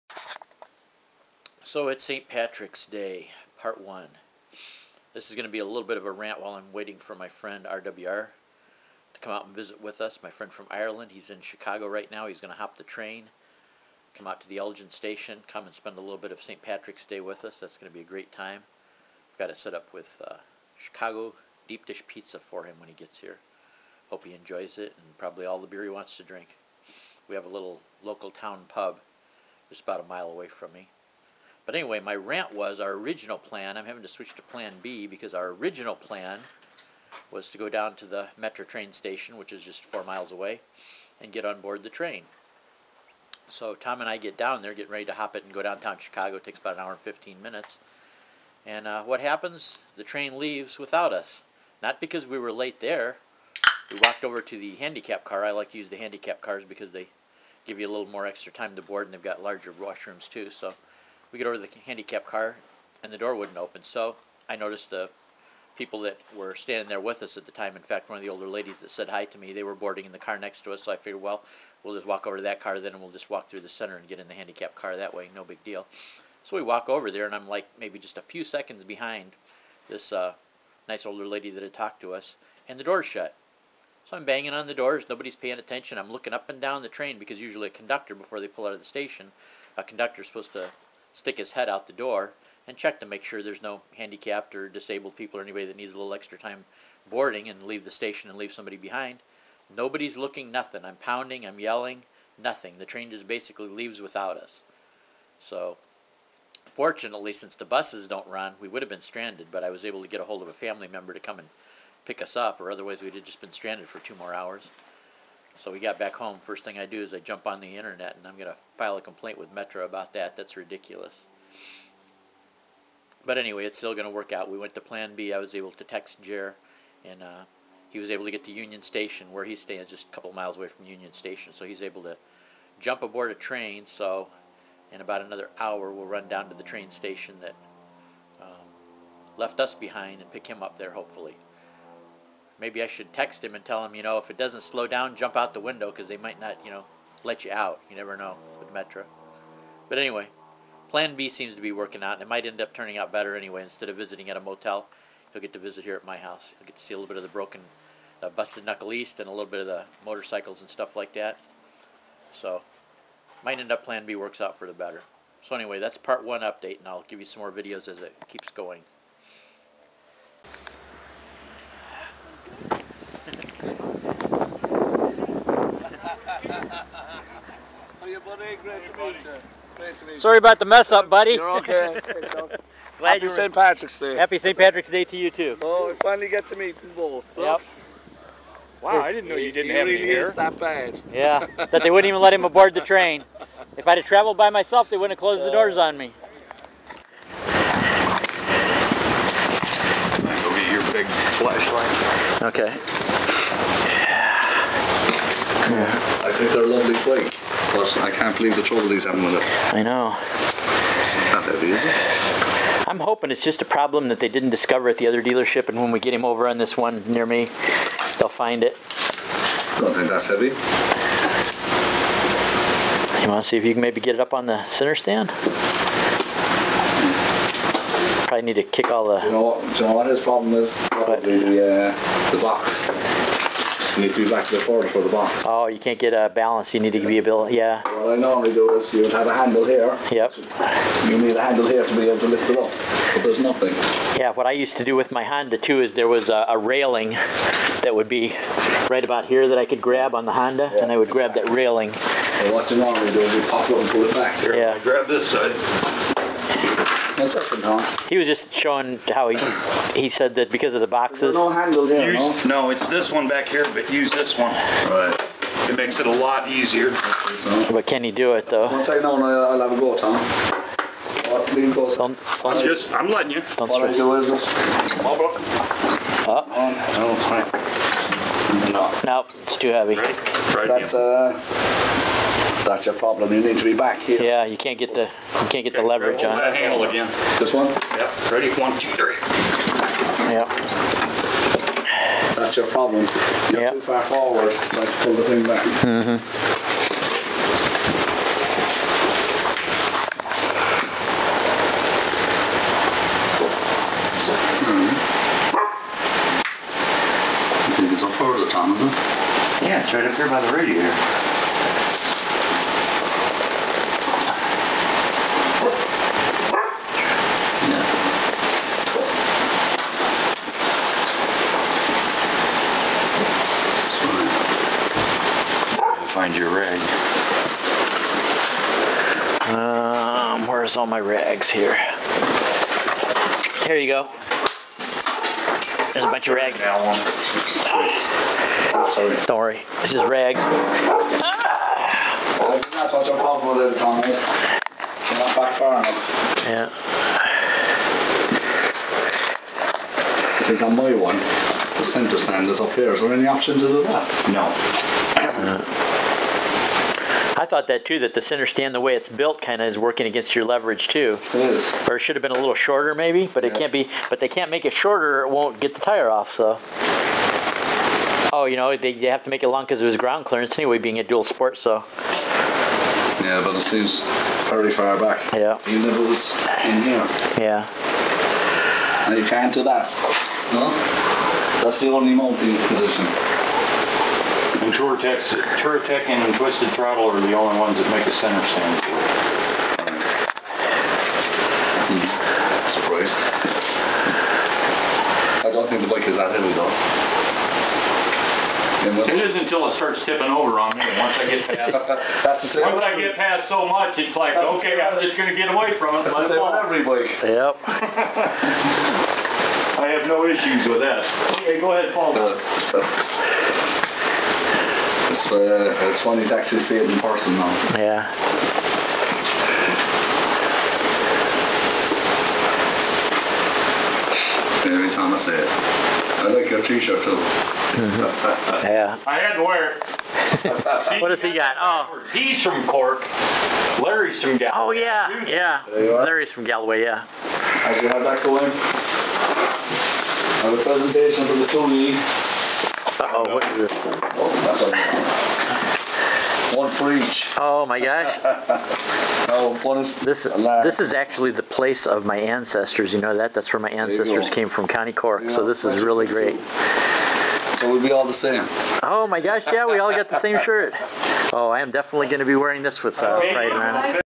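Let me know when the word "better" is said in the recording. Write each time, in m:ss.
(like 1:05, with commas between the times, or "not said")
2:33, 2:44.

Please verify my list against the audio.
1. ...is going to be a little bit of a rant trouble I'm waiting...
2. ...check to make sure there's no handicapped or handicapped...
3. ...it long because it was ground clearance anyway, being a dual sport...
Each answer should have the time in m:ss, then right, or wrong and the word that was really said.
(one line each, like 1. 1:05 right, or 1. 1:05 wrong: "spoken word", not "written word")
1. 0:05 wrong: "while", not "trouble"
2. 1:32 wrong: "disabled", not "handicapped"
3. 6:09 right.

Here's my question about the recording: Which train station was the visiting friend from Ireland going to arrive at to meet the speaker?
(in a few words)
Elgin Station.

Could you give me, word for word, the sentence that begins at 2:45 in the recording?
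So anyway, that's part one update, and I'll give you some more videos as it keeps going.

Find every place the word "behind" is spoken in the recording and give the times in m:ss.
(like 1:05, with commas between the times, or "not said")
1:18, 1:38, 2:19.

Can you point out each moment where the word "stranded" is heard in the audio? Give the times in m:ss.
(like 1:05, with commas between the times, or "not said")
1:49, 1:53.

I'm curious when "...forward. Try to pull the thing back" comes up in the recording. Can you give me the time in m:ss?
4:54.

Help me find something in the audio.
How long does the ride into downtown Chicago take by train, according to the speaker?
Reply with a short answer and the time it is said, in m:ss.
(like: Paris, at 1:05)
1 hour 15 minutes, at 0:46.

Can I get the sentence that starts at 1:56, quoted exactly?
First thing I do is I jump on the internet and I'm going to file a complaint with Metra about that.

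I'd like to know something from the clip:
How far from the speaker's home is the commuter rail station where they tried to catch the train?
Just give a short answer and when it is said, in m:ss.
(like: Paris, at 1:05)
4 miles, at 0:39.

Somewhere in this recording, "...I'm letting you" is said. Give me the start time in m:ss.
4:32.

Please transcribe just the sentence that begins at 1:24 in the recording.
So I'm banging on the doors.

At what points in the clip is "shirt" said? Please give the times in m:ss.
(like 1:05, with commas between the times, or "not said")
7:06, 7:40.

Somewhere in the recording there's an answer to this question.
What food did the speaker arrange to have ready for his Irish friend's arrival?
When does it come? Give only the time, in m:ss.
0:20.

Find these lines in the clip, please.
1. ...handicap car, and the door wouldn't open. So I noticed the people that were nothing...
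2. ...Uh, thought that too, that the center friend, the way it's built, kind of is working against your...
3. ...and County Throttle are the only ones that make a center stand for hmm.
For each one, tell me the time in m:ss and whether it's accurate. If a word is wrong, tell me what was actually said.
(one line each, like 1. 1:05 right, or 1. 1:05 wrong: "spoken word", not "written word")
1. 1:01 wrong: "standing", not "nothing"
2. 5:55 wrong: "stand", not "friend"
3. 6:26 wrong: "Twisted", not "County".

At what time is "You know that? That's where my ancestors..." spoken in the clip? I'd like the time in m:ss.
7:32.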